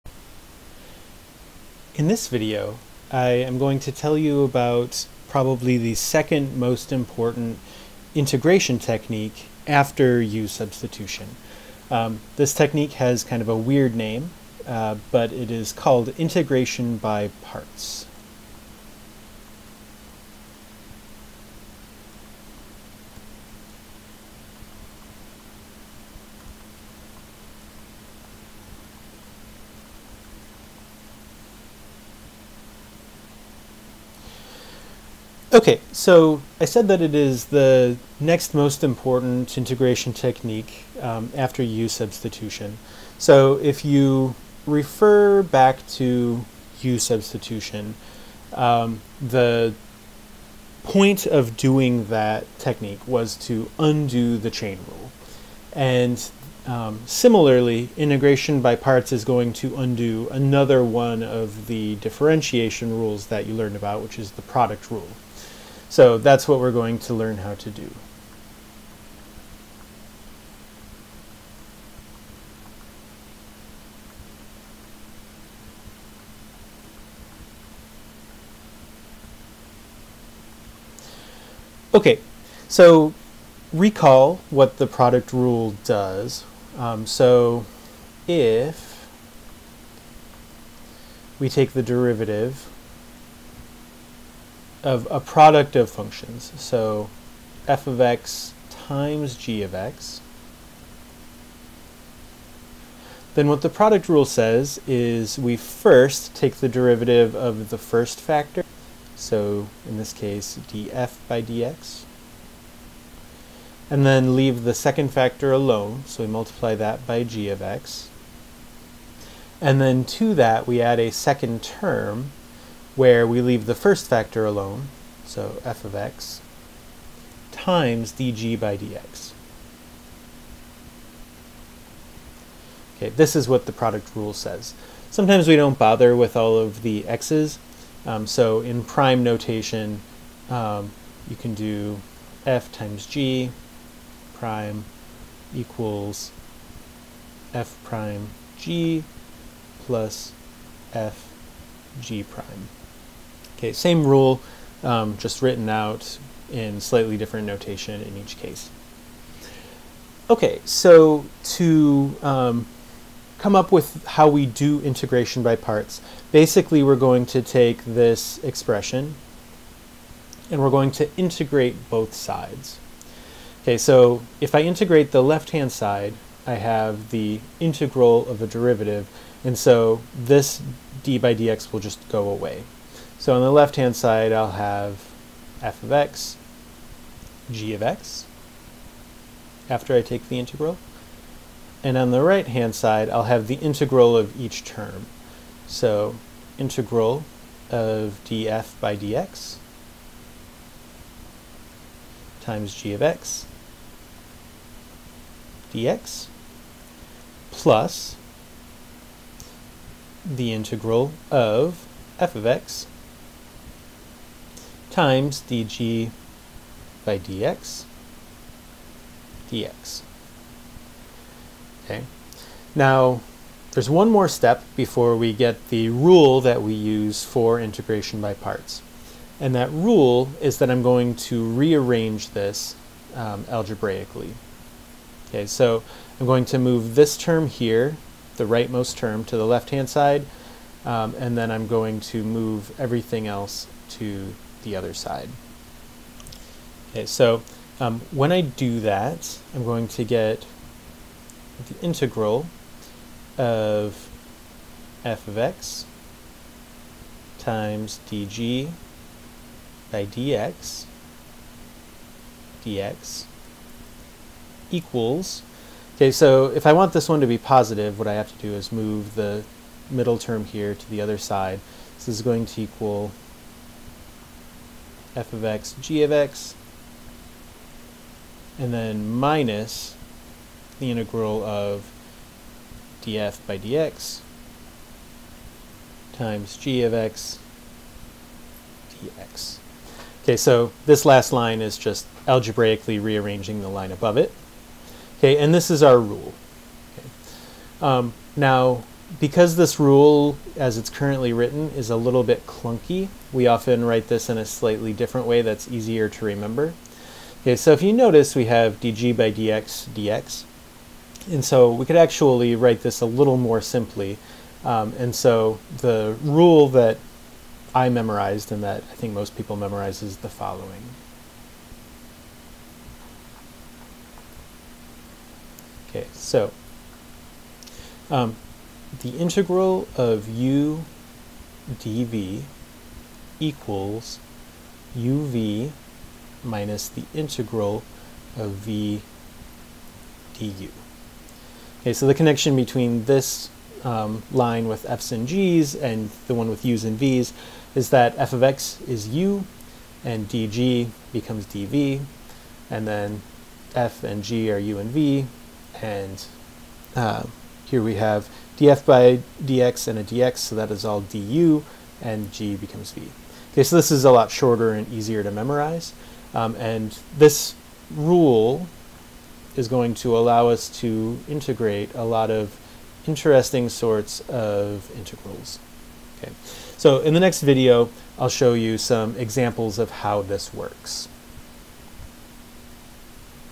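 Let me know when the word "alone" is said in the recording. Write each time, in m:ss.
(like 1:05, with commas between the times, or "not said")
1:55, 2:04.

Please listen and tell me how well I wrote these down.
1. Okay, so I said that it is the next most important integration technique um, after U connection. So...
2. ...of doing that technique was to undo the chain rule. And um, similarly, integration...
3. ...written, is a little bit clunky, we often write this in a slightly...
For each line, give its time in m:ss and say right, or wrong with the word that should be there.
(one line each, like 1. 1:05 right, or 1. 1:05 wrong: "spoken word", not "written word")
1. 0:35 wrong: "substitution", not "connection"
2. 0:51 right
3. 5:01 right.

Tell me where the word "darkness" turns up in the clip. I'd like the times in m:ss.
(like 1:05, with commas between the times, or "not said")
not said.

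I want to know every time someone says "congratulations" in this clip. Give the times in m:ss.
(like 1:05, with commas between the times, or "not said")
not said.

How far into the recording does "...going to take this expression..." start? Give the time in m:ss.
2:46.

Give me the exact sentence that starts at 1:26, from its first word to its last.
Um, so if we take the derivative of a product of functions.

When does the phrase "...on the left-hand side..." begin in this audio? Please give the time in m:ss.
3:03.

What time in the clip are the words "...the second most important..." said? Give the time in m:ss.
0:05.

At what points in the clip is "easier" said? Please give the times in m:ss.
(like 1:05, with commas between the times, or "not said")
5:05, 6:04.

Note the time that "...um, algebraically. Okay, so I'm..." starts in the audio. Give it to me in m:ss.
3:53.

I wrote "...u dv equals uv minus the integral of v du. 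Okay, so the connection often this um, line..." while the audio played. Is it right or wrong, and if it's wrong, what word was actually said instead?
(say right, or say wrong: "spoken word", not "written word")
wrong: "between", not "often".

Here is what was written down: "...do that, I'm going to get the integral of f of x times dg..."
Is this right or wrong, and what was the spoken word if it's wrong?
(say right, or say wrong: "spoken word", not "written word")
right.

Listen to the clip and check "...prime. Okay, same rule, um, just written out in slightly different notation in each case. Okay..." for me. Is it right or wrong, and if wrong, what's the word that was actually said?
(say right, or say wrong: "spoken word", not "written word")
right.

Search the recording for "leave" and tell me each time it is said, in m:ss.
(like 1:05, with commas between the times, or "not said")
1:54, 2:03.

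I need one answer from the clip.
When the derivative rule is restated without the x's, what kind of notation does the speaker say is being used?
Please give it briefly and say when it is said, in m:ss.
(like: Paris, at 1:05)
prime notation, at 2:18.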